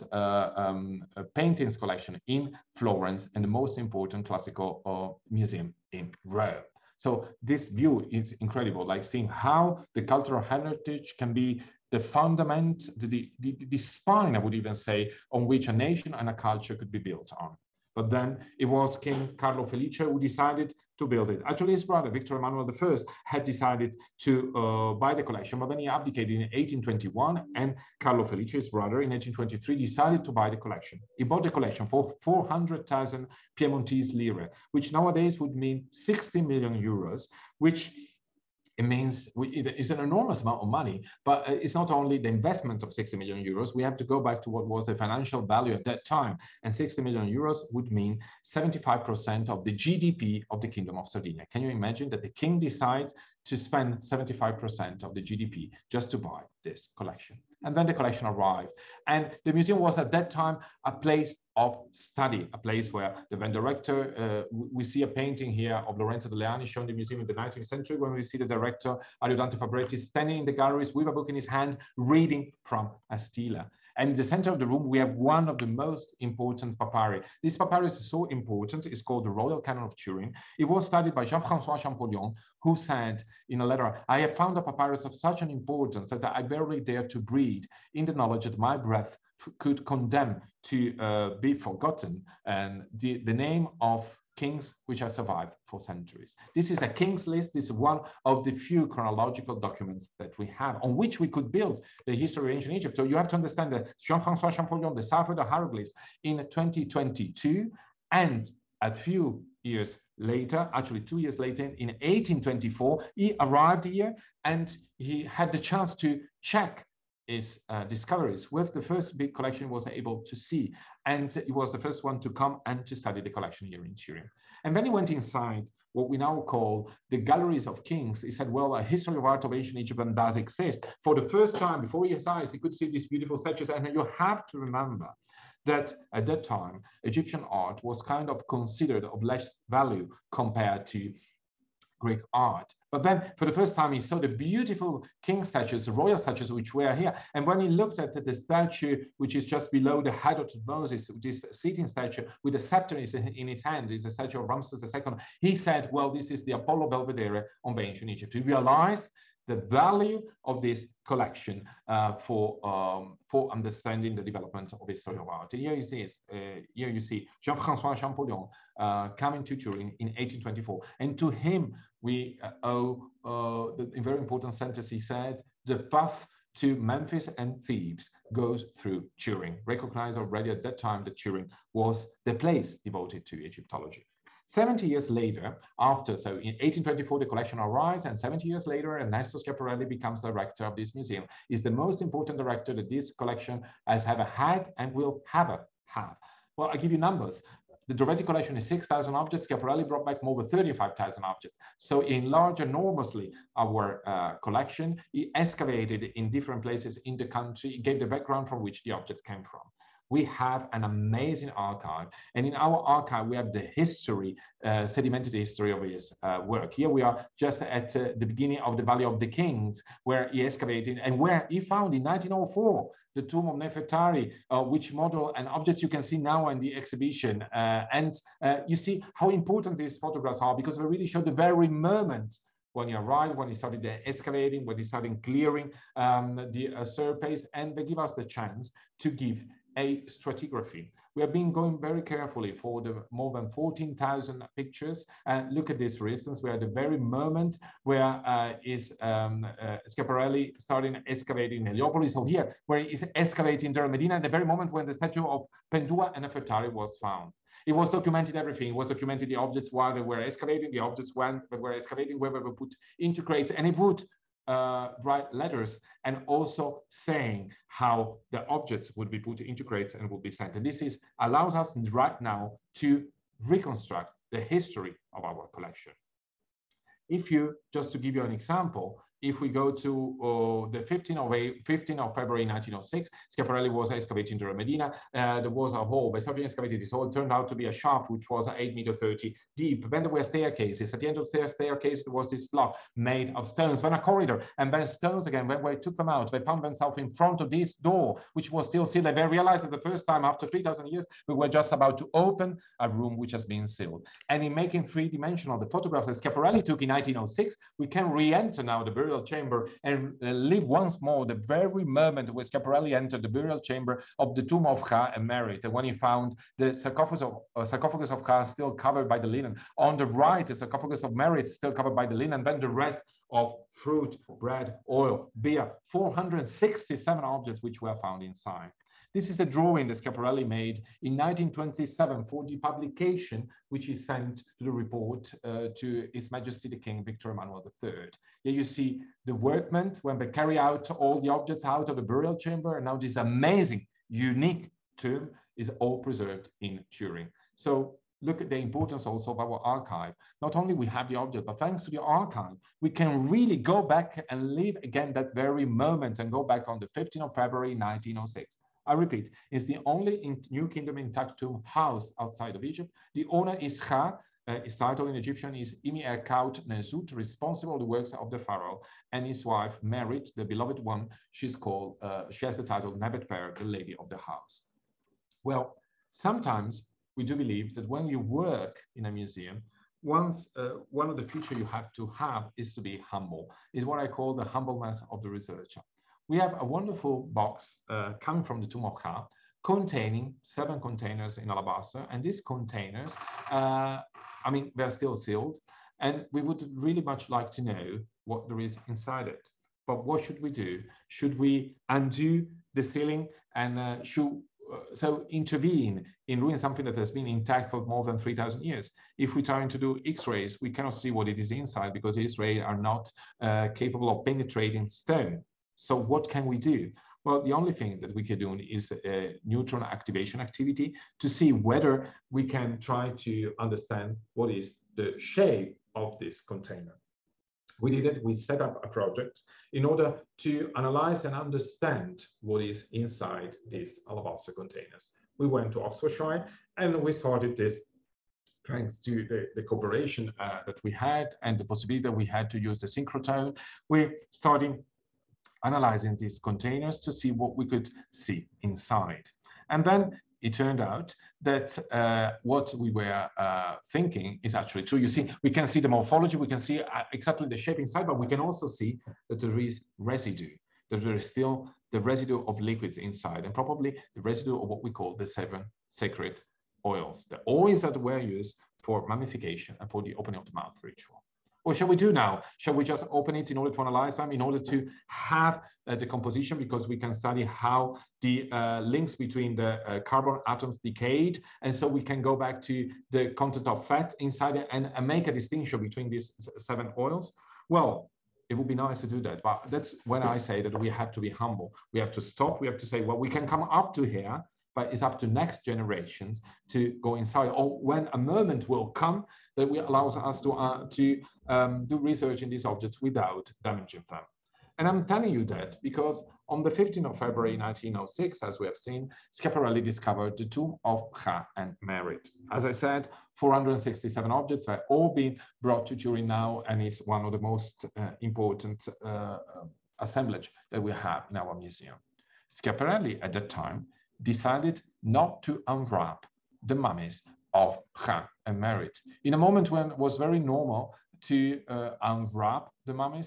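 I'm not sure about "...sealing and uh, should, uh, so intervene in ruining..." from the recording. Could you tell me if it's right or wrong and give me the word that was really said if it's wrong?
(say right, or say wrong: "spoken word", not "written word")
right.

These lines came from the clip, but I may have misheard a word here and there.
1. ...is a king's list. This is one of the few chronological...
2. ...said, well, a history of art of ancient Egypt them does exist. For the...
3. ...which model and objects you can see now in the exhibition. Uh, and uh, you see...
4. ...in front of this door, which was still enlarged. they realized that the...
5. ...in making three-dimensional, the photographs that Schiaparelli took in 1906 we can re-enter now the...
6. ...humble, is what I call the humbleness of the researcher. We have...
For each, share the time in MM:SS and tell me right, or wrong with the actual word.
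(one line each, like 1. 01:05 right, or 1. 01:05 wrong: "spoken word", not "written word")
1. 01:36 right
2. 02:08 right
3. 03:44 right
4. 04:56 wrong: "sealed", not "enlarged"
5. 05:04 right
6. 06:23 right.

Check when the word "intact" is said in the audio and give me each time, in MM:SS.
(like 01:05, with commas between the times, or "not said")
06:00, 06:47.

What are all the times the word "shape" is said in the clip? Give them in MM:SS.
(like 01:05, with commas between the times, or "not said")
07:05, 07:37.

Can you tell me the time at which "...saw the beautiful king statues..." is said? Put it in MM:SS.
02:23.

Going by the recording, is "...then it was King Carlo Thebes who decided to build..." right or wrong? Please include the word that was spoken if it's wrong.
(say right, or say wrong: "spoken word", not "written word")
wrong: "Felice", not "Thebes".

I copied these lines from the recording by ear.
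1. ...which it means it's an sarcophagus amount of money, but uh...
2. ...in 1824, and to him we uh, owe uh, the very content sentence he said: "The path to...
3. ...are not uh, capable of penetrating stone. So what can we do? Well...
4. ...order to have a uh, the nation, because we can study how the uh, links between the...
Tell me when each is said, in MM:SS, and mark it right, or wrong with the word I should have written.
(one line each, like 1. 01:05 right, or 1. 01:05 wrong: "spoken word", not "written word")
1. 00:37 wrong: "enormous", not "sarcophagus"
2. 02:49 wrong: "important", not "content"
3. 06:52 right
4. 07:54 wrong: "composition", not "nation".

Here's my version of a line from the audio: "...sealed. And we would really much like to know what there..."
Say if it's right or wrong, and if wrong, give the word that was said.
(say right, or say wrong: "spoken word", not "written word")
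right.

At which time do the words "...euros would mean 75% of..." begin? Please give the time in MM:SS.
00:47.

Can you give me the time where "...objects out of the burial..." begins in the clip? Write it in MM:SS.
05:41.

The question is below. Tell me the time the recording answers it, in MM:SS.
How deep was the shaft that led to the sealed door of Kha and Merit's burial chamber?
04:48.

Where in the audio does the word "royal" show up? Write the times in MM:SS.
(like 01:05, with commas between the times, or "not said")
01:19, 02:25.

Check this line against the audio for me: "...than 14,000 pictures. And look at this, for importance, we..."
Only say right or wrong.
wrong.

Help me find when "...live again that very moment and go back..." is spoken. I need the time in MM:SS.
05:54.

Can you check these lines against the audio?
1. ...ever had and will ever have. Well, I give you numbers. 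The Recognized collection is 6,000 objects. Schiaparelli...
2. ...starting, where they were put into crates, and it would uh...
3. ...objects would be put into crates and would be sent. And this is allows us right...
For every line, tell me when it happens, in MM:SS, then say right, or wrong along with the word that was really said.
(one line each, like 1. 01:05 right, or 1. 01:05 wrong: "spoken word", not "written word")
1. 03:14 wrong: "Drovetti", not "Recognized"
2. 04:21 wrong: "excavating", not "starting"
3. 04:28 right.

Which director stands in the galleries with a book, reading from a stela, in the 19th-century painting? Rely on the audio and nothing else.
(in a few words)
Ariodante Fabretti.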